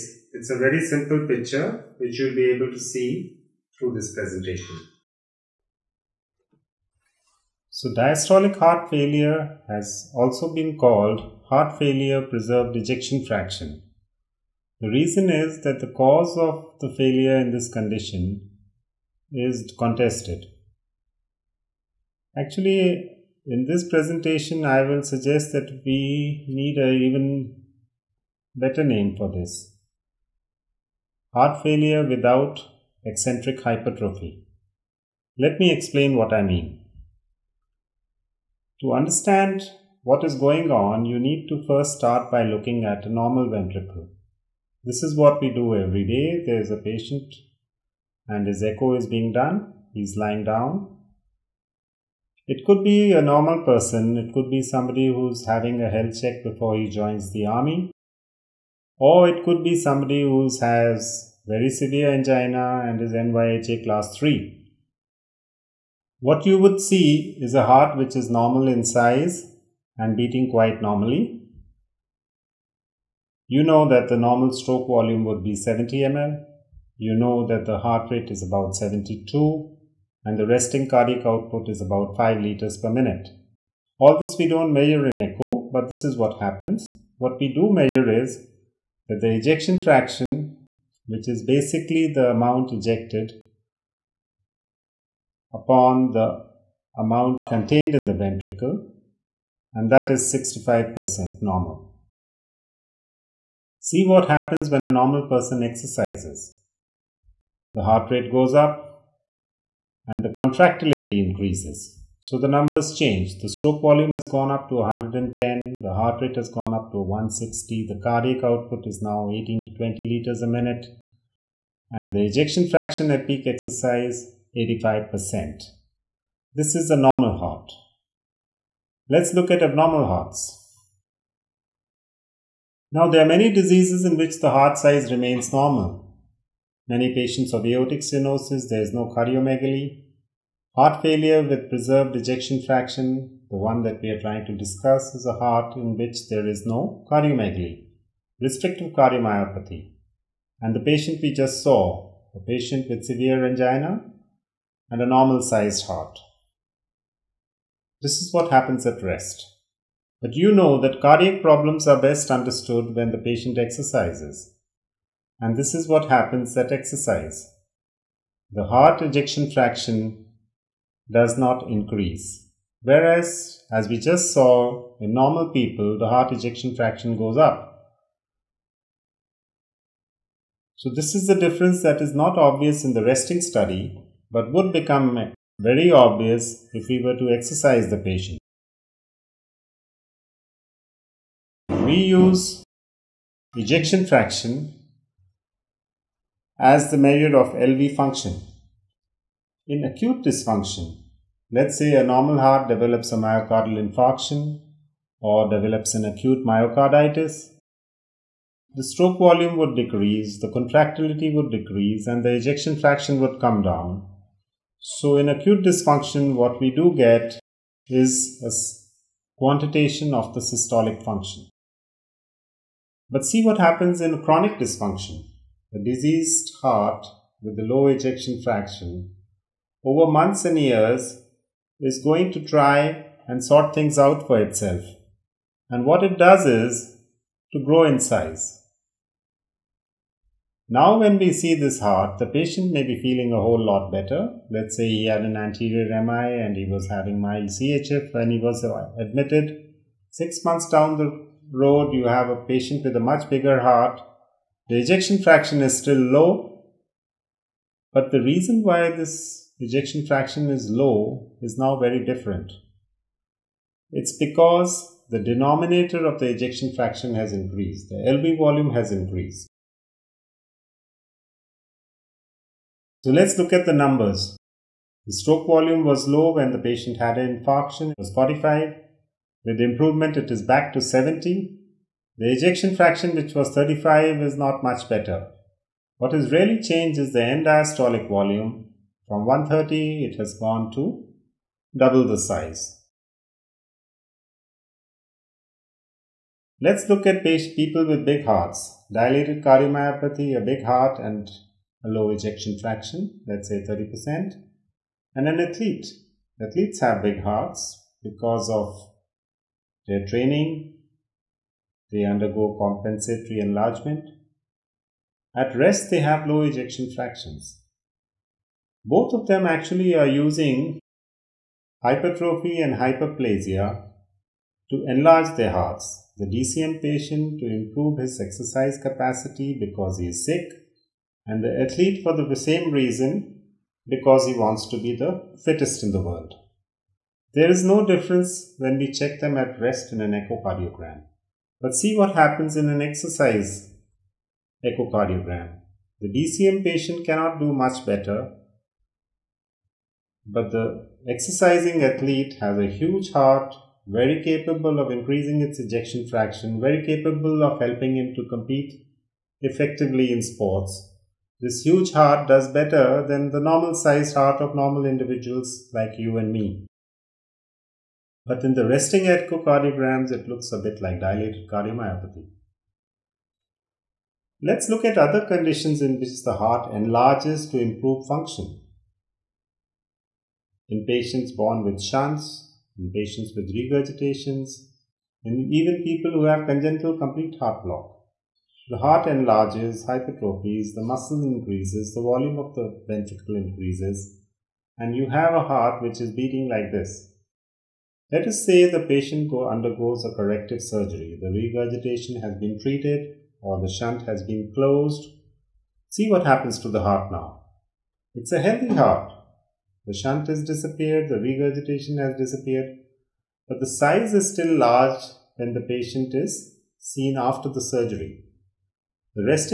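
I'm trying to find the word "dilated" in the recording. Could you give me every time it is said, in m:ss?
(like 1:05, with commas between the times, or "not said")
4:58, 6:11.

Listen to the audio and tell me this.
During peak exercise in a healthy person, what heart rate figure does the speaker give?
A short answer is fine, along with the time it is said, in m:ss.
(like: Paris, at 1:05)
160, at 1:57.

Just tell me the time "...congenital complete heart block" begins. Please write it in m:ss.
6:26.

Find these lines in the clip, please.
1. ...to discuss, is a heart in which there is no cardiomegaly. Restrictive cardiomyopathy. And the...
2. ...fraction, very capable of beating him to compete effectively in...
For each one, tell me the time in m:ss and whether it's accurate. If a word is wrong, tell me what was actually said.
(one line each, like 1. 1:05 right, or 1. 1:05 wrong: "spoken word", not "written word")
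1. 2:24 right
2. 5:56 wrong: "helping", not "beating".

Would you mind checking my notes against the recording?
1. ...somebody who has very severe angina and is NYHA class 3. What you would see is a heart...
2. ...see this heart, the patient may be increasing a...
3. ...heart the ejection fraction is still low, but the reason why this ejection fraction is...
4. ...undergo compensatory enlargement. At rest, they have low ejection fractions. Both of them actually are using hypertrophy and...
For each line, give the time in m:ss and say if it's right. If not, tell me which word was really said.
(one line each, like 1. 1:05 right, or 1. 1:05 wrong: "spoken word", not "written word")
1. 0:59 right
2. 4:01 wrong: "feeling", not "increasing"
3. 4:13 right
4. 5:12 right.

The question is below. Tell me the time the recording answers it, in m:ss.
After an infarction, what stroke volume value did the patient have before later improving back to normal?
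4:38.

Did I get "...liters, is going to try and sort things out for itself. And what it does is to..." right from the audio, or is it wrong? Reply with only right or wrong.
wrong.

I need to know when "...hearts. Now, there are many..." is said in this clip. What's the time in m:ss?
2:10.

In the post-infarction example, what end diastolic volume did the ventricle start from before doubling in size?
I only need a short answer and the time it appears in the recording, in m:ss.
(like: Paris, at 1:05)
130, at 4:49.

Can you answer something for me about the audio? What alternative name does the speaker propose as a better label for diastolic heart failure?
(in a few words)
Heart failure without eccentric hypertrophy.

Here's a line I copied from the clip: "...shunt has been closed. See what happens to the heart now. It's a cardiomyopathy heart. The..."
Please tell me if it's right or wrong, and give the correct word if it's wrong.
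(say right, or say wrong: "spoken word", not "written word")
wrong: "healthy", not "cardiomyopathy".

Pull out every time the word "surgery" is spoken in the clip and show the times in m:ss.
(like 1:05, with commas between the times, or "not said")
6:40, 6:57.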